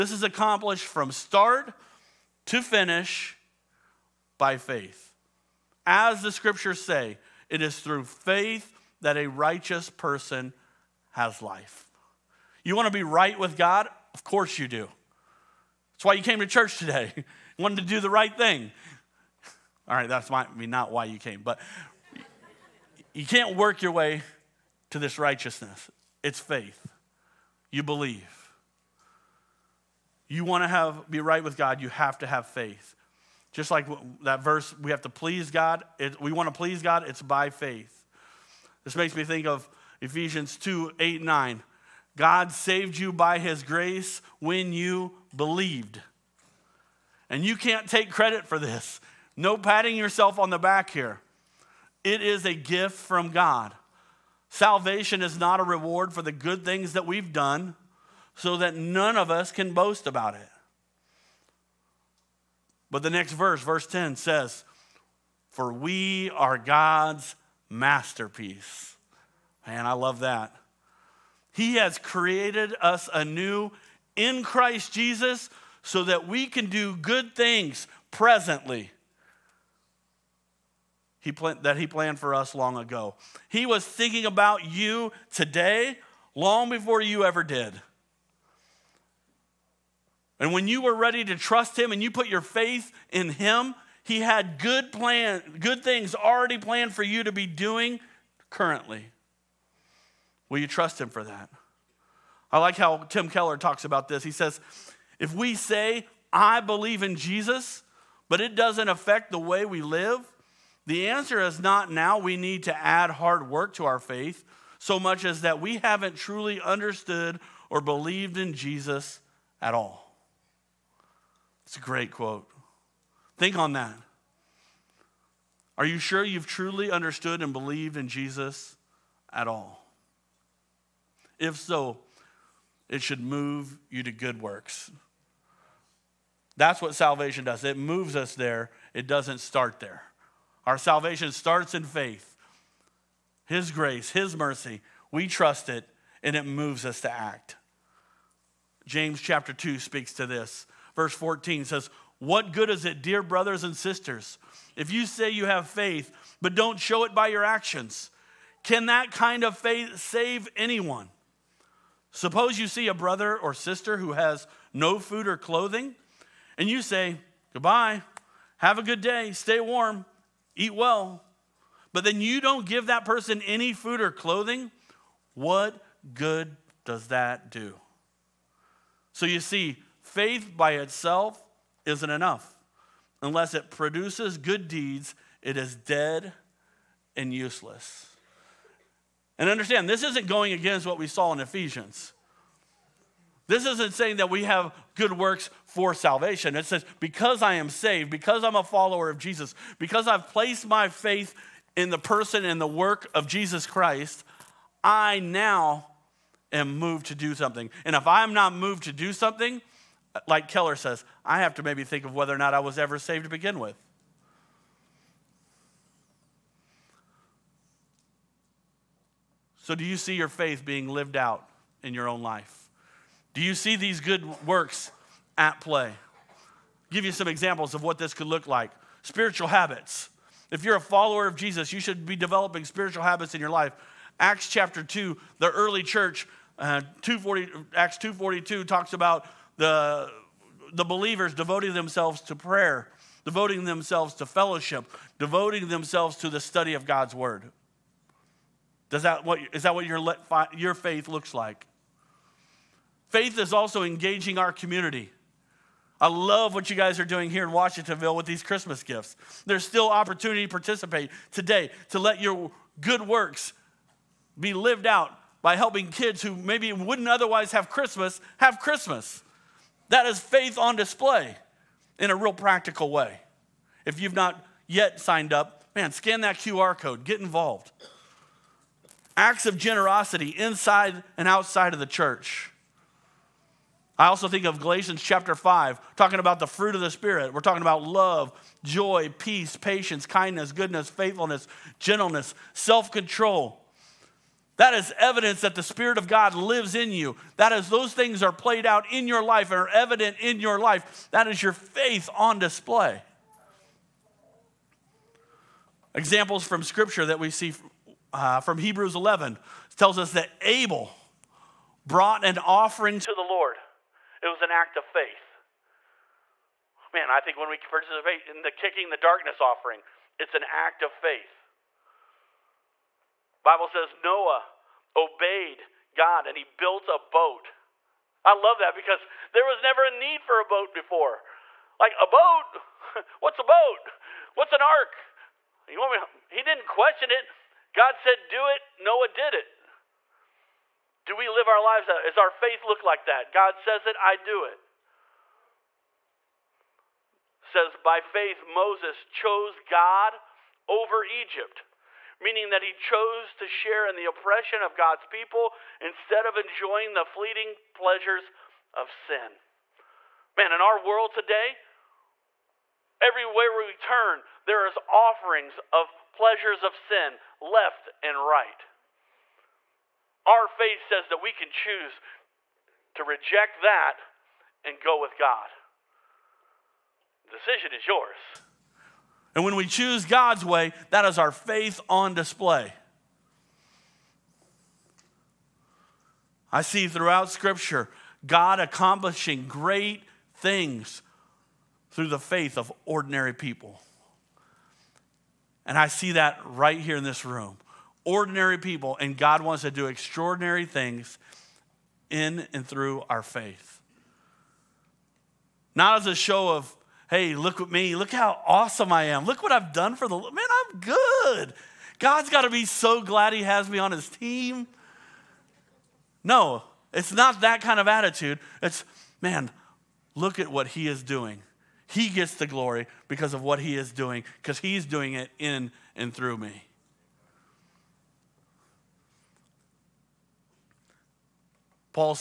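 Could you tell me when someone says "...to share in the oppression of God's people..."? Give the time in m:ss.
5:53.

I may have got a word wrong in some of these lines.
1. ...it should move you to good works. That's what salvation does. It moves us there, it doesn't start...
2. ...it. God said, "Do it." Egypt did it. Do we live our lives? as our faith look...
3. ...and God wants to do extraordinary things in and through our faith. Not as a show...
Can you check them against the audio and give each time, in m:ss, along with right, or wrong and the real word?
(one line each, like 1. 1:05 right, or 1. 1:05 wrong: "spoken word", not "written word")
1. 2:12 right
2. 5:37 wrong: "Noah", not "Egypt"
3. 6:38 right.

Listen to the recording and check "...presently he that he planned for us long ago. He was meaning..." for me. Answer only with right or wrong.
wrong.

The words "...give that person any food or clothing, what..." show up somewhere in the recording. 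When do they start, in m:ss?
2:52.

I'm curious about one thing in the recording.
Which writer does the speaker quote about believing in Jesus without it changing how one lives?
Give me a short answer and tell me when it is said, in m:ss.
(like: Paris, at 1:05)
Tim Keller, at 1:43.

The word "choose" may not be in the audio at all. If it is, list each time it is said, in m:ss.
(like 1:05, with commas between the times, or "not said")
6:11, 6:19.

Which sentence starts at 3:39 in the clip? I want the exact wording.
So, do you see your faith being lived out in your own life?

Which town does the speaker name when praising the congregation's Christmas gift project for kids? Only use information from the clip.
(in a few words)
Washingtonville.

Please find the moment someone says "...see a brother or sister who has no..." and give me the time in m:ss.
2:42.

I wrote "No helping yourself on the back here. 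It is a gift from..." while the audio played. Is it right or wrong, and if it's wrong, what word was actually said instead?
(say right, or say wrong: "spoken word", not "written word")
wrong: "patting", not "helping".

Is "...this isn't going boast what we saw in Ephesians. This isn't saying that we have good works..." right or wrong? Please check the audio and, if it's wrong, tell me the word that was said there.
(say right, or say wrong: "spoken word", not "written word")
wrong: "against", not "boast".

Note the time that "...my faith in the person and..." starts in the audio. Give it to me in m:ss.
3:20.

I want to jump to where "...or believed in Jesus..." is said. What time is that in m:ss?
1:57.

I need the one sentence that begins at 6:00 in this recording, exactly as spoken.
Man, in our world today, everywhere we turn, there is offerings of pleasures of sin left and right.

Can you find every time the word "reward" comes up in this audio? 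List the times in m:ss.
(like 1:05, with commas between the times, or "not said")
0:55.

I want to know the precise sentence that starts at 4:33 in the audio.
If you've not yet signed up, man, scan that QR code, get involved.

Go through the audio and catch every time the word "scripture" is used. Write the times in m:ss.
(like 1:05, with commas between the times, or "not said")
0:06, 5:06, 6:27.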